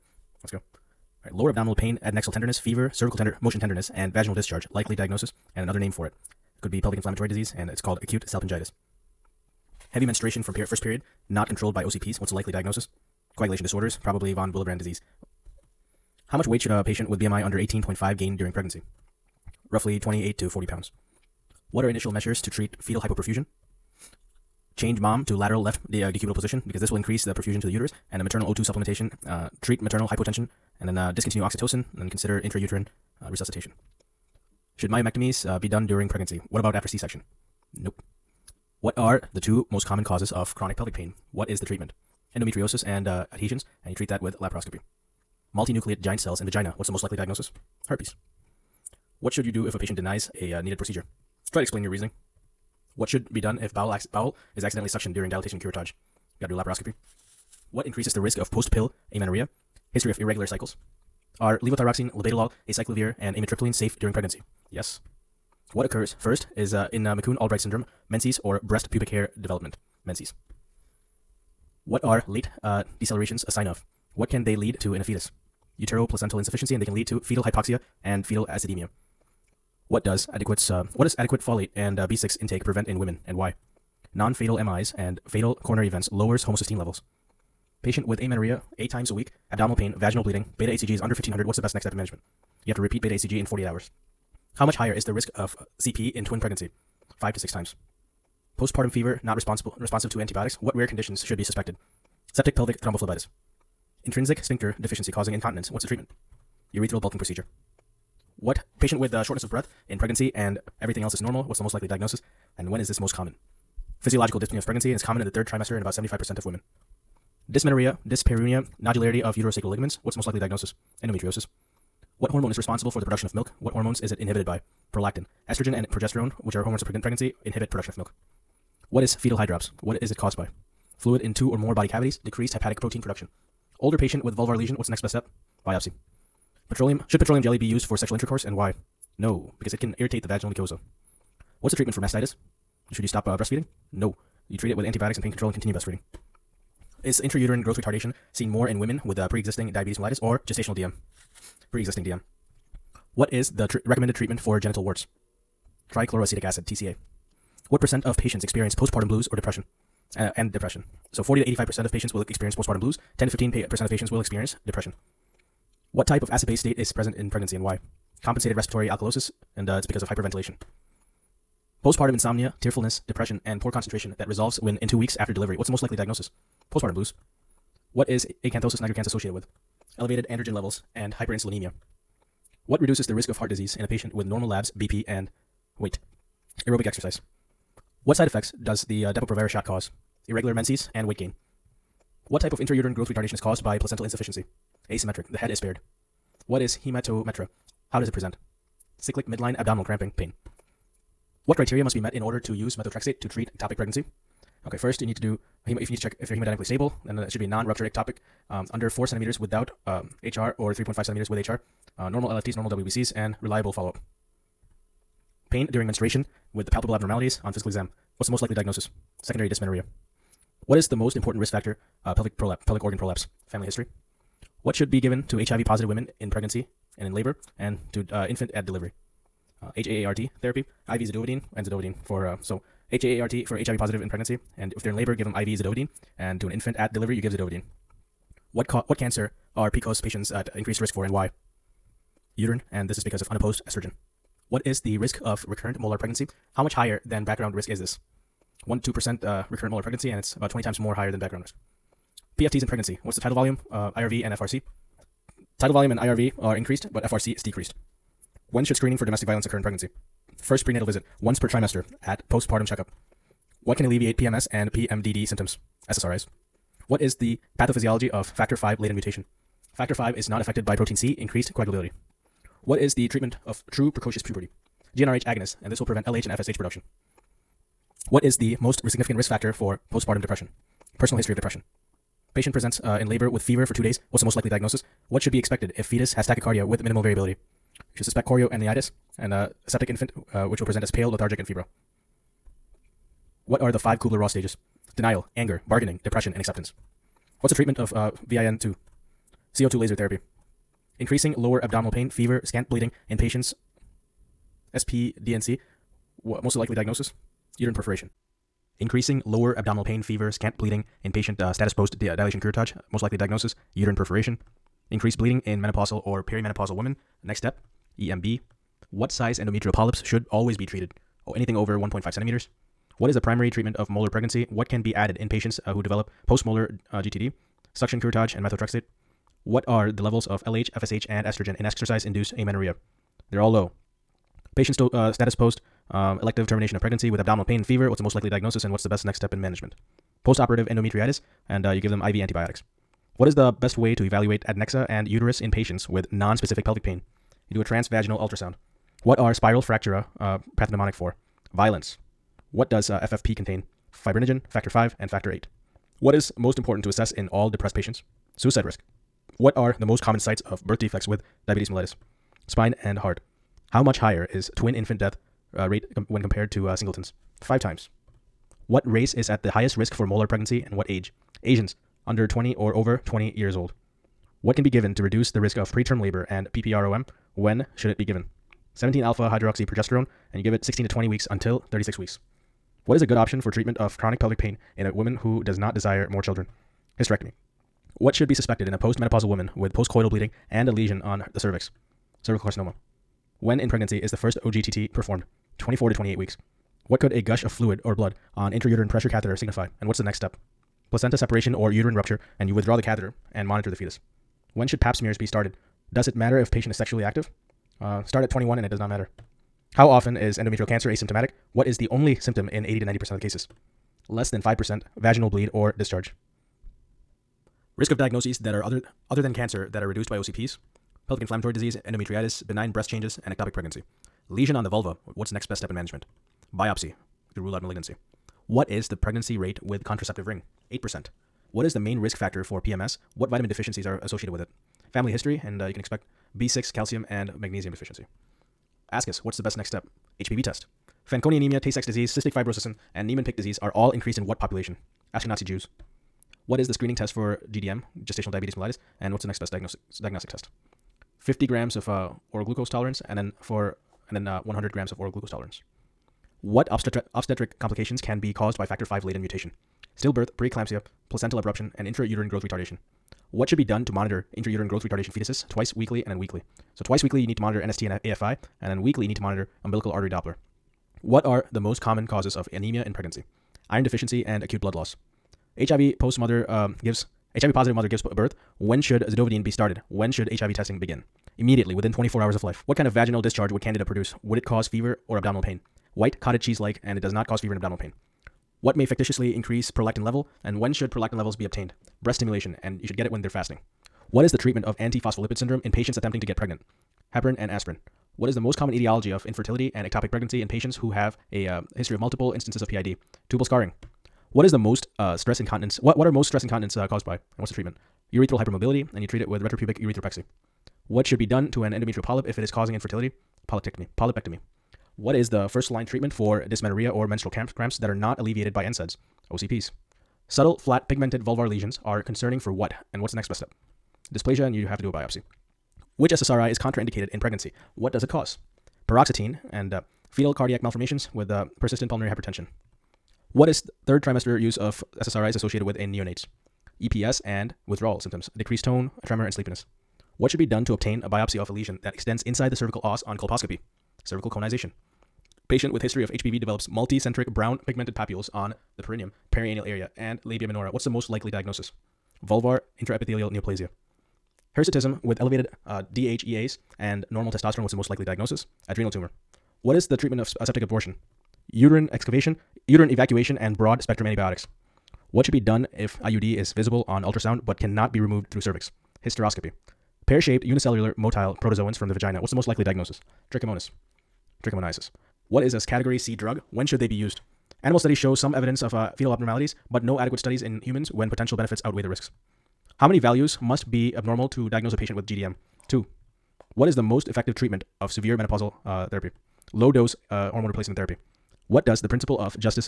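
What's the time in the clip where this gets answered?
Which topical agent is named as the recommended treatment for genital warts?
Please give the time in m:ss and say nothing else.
2:35.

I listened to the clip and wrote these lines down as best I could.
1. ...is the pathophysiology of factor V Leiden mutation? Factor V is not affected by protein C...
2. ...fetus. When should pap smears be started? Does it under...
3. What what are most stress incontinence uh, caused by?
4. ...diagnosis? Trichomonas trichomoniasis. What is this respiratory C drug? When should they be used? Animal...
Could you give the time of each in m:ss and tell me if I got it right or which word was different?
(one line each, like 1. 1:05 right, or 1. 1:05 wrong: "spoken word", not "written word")
1. 4:26 right
2. 6:43 wrong: "matter", not "under"
3. 8:25 right
4. 9:32 wrong: "category", not "respiratory".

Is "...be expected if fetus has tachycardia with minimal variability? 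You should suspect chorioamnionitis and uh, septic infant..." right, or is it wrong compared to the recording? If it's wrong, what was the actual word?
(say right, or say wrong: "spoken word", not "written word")
right.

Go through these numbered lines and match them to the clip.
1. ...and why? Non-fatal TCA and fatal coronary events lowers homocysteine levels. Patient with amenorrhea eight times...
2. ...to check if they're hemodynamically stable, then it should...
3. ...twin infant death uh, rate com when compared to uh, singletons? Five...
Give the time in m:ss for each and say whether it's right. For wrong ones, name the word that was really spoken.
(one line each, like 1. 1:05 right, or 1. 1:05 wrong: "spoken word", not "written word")
1. 1:23 wrong: "MIs", not "TCA"
2. 3:25 right
3. 6:04 right.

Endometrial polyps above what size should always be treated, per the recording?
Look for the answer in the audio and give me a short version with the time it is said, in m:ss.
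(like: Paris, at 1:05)
1.5 centimeters, at 5:21.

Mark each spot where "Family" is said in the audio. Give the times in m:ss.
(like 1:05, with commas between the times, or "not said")
3:43, 7:14.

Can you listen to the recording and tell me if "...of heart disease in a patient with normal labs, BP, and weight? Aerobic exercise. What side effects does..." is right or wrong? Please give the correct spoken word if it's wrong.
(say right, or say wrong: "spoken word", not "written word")
right.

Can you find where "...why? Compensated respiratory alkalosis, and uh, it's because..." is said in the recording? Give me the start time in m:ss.
2:47.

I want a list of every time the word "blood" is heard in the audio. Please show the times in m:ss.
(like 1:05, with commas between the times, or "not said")
6:37, 7:54.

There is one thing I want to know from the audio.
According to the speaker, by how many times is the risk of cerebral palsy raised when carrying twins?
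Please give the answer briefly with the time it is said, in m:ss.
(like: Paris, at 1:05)
5 to 6 times, at 1:37.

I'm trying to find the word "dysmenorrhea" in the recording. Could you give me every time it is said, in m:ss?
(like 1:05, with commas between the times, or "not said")
1:57, 3:39, 8:36.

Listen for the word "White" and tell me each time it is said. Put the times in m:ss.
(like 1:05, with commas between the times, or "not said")
8:05.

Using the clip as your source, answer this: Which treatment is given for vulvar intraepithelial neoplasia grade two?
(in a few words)
CO2 laser therapy.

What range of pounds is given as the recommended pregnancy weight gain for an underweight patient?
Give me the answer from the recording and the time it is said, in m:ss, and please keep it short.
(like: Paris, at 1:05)
28 to 40 pounds, at 0:19.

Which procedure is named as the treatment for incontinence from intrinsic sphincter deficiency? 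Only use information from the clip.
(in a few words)
Urethral bulking procedure.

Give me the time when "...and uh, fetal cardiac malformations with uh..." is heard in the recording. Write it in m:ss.
8:49.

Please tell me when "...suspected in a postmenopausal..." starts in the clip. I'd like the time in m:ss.
6:28.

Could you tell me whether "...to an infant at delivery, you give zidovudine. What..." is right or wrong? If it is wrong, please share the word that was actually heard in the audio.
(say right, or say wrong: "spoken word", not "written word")
right.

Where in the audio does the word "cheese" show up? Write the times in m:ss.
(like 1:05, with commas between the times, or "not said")
8:06.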